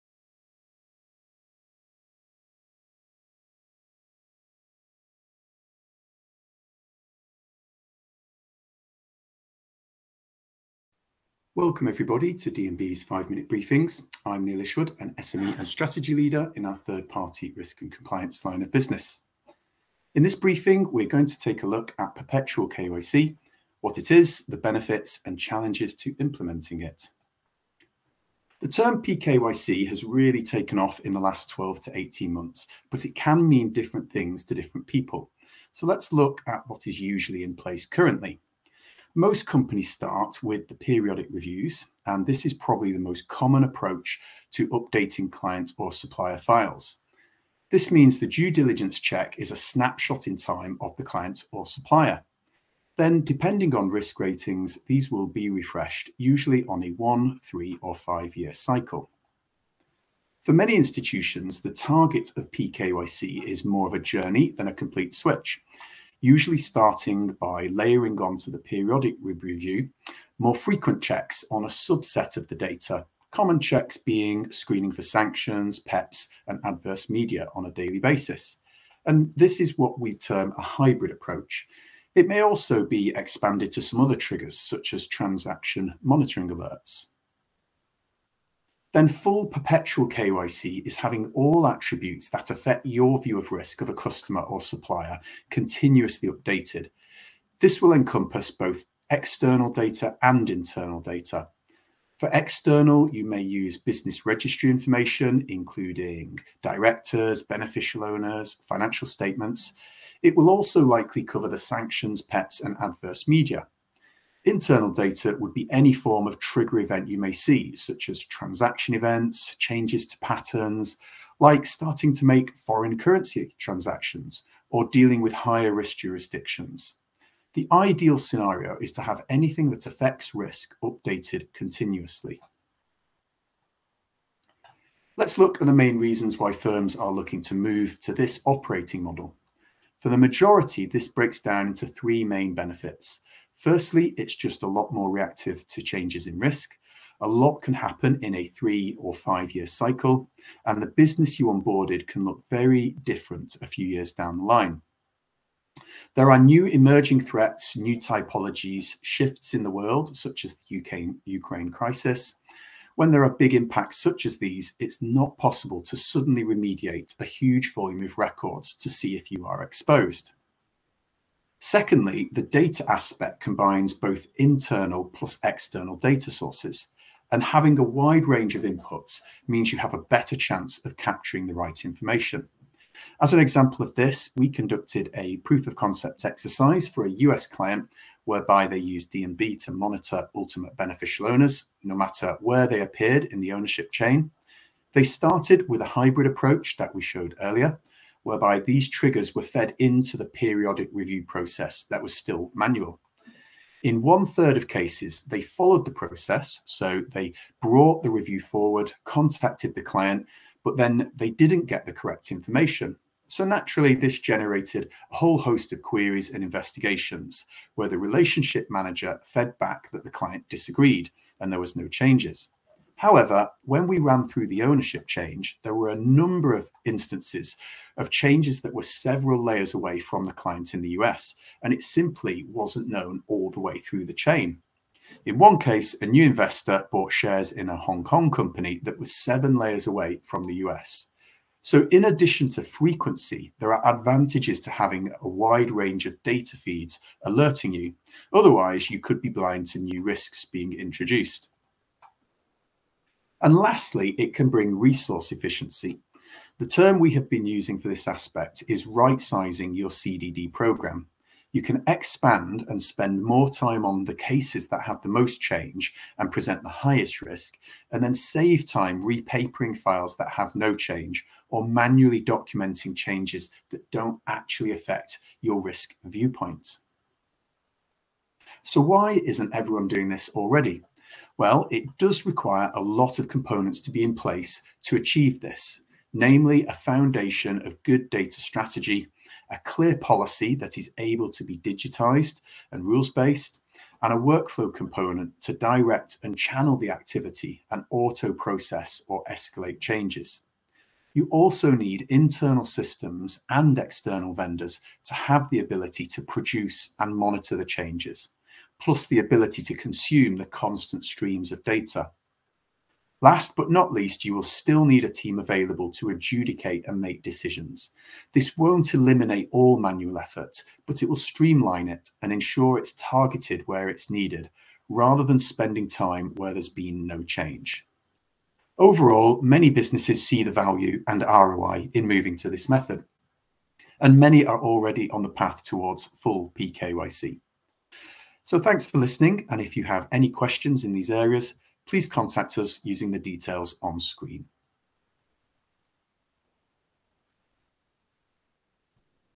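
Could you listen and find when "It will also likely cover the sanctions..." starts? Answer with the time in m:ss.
1:50.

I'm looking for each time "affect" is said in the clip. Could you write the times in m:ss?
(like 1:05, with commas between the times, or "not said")
1:32, 2:09, 4:34.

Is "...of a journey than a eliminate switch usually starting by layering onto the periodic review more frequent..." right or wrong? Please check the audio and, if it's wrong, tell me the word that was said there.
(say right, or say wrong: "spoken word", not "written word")
wrong: "complete", not "eliminate".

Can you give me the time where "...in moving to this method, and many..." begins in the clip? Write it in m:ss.
5:31.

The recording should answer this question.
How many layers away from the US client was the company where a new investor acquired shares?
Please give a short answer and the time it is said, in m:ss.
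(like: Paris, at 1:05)
7, at 3:59.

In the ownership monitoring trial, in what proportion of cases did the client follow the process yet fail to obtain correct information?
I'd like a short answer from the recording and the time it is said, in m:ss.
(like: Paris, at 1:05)
One third, at 3:24.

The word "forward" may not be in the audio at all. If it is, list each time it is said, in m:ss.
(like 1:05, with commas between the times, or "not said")
3:28.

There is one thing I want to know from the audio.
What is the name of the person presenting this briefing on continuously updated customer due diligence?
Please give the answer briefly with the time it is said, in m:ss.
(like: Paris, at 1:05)
Neil Isherwood, at 0:14.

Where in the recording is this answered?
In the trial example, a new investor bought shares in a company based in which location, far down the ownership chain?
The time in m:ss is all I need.
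3:57.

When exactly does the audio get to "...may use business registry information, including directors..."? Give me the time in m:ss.
1:43.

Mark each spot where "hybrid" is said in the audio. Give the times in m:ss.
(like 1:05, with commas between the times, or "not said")
1:20, 3:15.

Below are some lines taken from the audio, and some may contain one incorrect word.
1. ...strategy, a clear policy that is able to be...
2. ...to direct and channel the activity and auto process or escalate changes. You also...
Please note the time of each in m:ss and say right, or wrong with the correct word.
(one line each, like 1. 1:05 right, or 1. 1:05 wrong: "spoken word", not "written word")
1. 4:48 right
2. 4:55 right.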